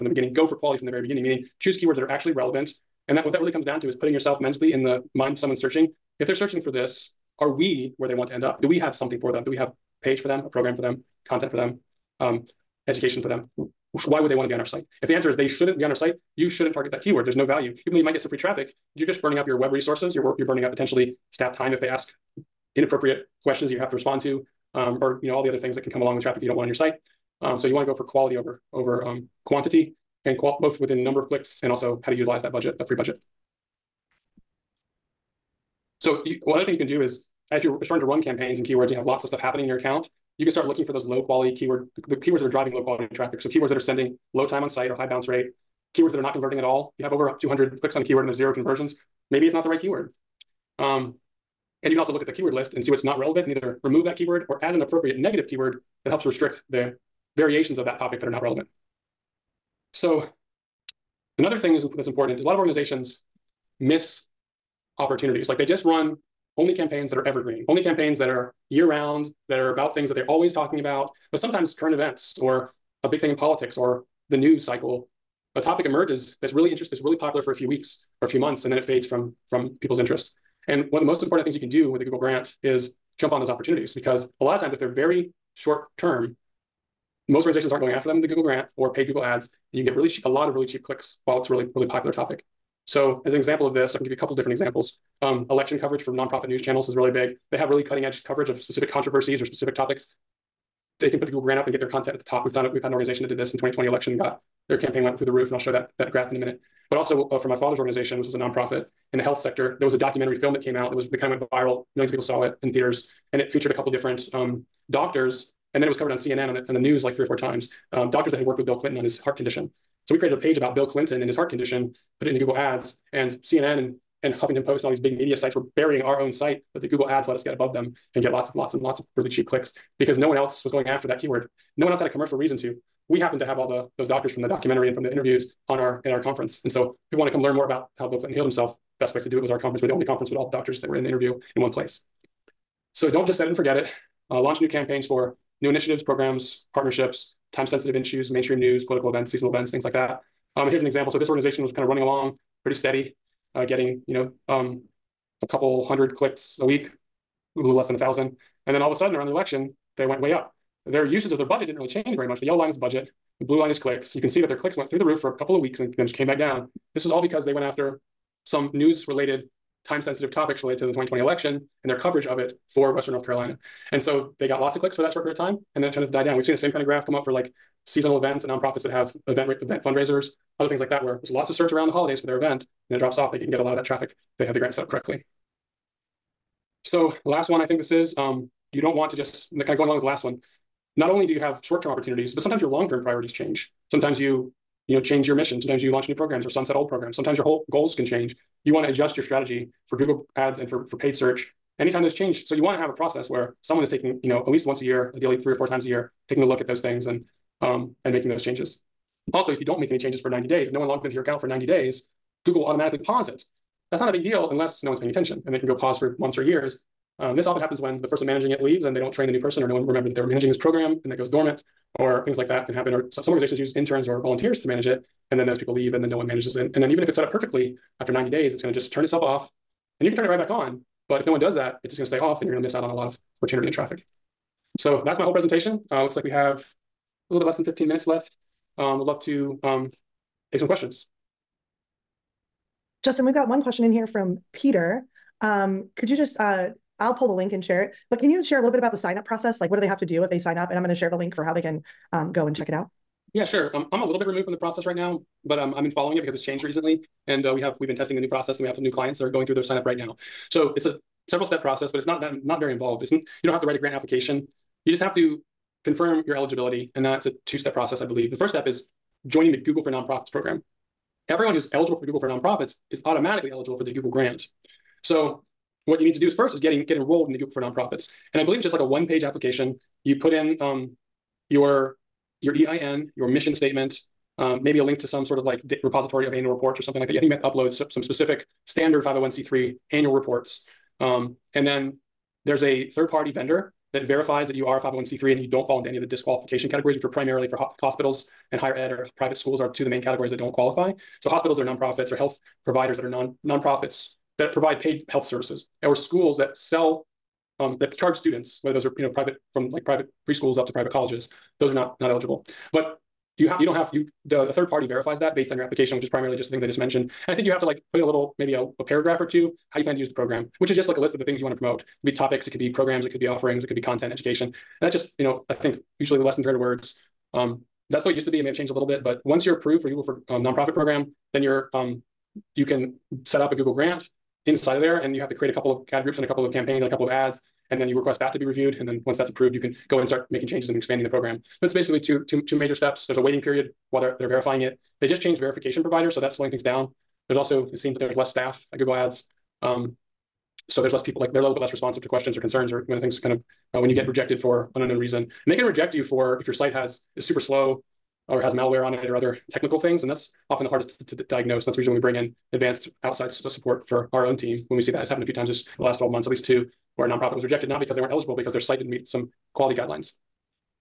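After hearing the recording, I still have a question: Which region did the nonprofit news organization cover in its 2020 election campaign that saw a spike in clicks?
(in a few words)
Western North Carolina.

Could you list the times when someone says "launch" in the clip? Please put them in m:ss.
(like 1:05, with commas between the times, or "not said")
2:24, 3:15.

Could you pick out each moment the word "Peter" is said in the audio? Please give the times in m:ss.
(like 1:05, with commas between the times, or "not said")
4:04.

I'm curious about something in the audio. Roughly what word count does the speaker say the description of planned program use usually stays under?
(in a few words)
300 words.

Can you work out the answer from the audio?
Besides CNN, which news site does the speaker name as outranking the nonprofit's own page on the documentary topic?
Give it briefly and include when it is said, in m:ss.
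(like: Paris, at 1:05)
Huffington Post, at 2:04.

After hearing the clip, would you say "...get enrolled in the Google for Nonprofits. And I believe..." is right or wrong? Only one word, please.
right.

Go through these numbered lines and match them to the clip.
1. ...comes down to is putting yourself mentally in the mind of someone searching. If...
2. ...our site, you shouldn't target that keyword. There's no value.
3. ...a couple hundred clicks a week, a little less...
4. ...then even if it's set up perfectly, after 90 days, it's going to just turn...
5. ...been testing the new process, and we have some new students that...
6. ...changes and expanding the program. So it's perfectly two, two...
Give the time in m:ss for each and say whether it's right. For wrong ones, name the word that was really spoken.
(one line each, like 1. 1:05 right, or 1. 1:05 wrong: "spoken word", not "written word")
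1. 0:03 right
2. 0:15 right
3. 2:35 right
4. 3:46 right
5. 4:17 wrong: "clients", not "students"
6. 5:40 wrong: "basically", not "perfectly".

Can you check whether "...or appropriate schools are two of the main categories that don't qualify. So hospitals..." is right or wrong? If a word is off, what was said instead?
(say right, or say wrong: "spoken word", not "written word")
wrong: "private", not "appropriate".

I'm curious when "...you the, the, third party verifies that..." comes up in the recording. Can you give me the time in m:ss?
5:13.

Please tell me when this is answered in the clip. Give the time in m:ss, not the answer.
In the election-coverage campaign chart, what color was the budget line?
2:42.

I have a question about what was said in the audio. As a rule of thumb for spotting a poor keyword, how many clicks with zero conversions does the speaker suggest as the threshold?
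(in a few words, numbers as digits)
200.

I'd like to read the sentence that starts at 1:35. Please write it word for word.
Um, election coverage for nonprofit news channels is really big.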